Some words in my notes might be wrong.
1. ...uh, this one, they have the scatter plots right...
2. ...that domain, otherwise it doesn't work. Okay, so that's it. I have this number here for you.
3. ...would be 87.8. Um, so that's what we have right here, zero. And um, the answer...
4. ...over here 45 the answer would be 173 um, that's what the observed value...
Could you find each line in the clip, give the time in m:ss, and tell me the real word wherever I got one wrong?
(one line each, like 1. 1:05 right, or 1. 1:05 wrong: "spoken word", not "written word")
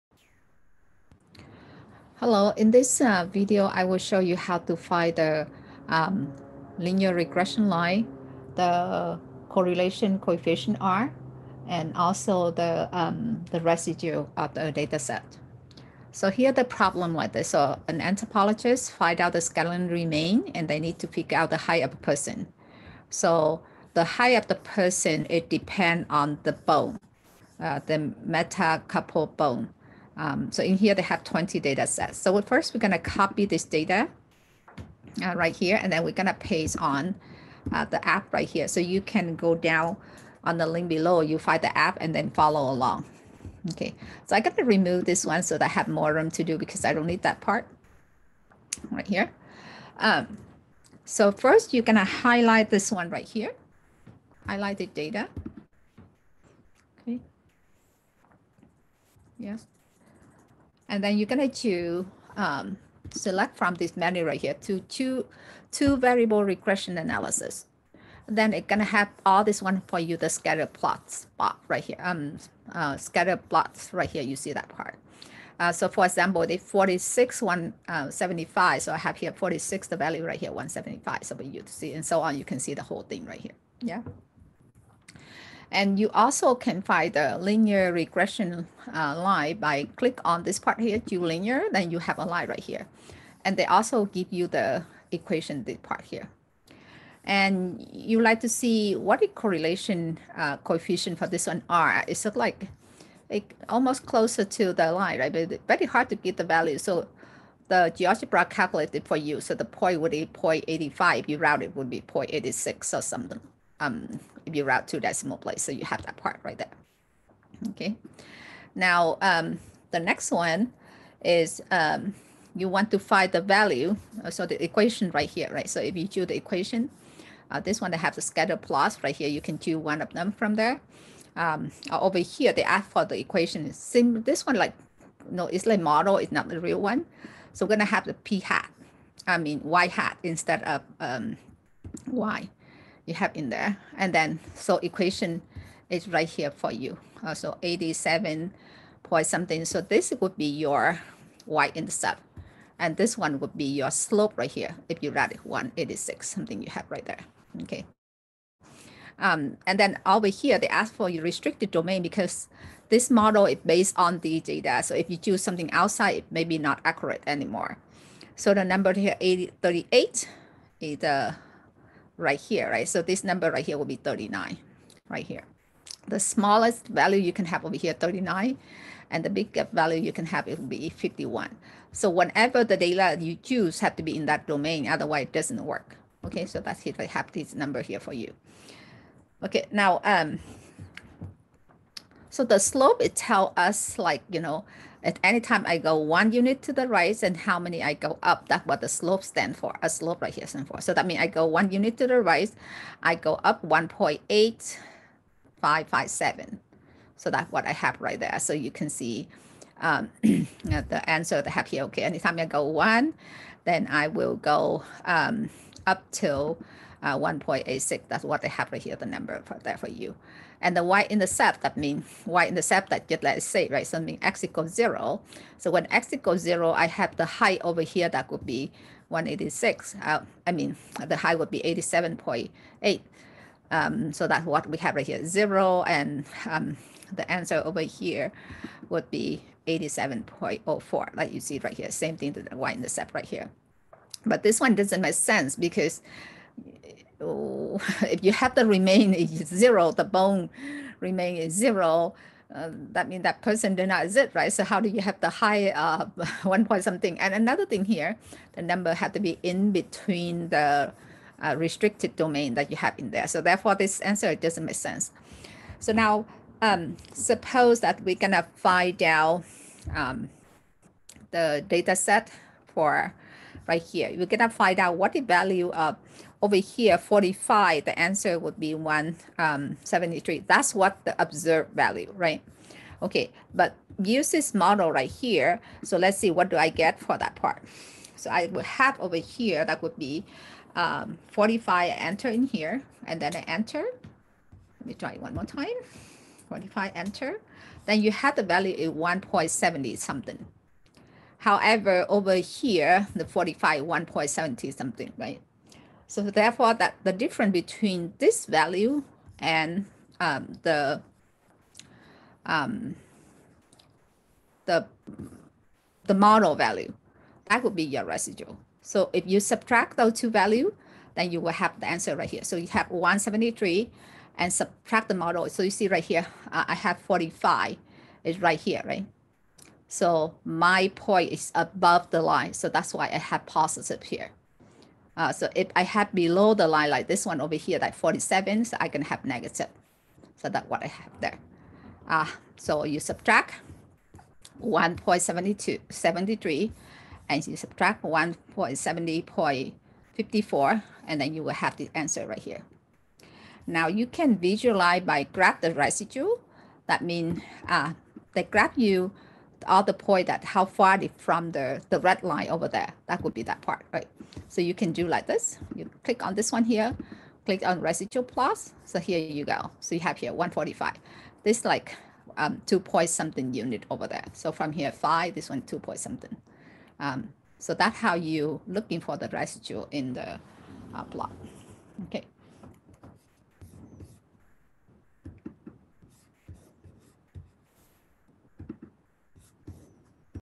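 1. 2:07 right
2. 3:04 right
3. 3:51 right
4. 4:36 right.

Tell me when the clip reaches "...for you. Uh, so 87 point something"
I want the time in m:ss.
2:26.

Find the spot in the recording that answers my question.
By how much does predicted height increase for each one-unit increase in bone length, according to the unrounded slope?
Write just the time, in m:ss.
3:23.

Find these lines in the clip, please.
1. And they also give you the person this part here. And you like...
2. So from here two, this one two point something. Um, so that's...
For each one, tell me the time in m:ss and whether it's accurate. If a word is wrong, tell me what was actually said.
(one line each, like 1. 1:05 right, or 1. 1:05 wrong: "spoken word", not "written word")
1. 1:33 wrong: "equation", not "person"
2. 6:14 wrong: "five", not "two".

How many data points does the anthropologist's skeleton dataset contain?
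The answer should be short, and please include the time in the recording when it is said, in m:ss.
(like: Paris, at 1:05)
20, at 0:31.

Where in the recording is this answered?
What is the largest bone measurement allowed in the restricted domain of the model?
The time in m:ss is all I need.
3:00.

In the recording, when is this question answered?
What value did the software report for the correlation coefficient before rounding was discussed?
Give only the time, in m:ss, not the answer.
1:50.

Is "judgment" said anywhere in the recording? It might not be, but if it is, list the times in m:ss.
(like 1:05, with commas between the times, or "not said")
not said.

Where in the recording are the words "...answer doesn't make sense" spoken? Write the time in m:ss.
4:24.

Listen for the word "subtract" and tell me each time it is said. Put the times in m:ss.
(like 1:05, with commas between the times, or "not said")
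5:19, 5:24, 5:42, 5:47.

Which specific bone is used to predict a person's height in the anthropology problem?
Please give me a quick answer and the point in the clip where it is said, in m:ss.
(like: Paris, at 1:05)
metacarpal bone, at 0:28.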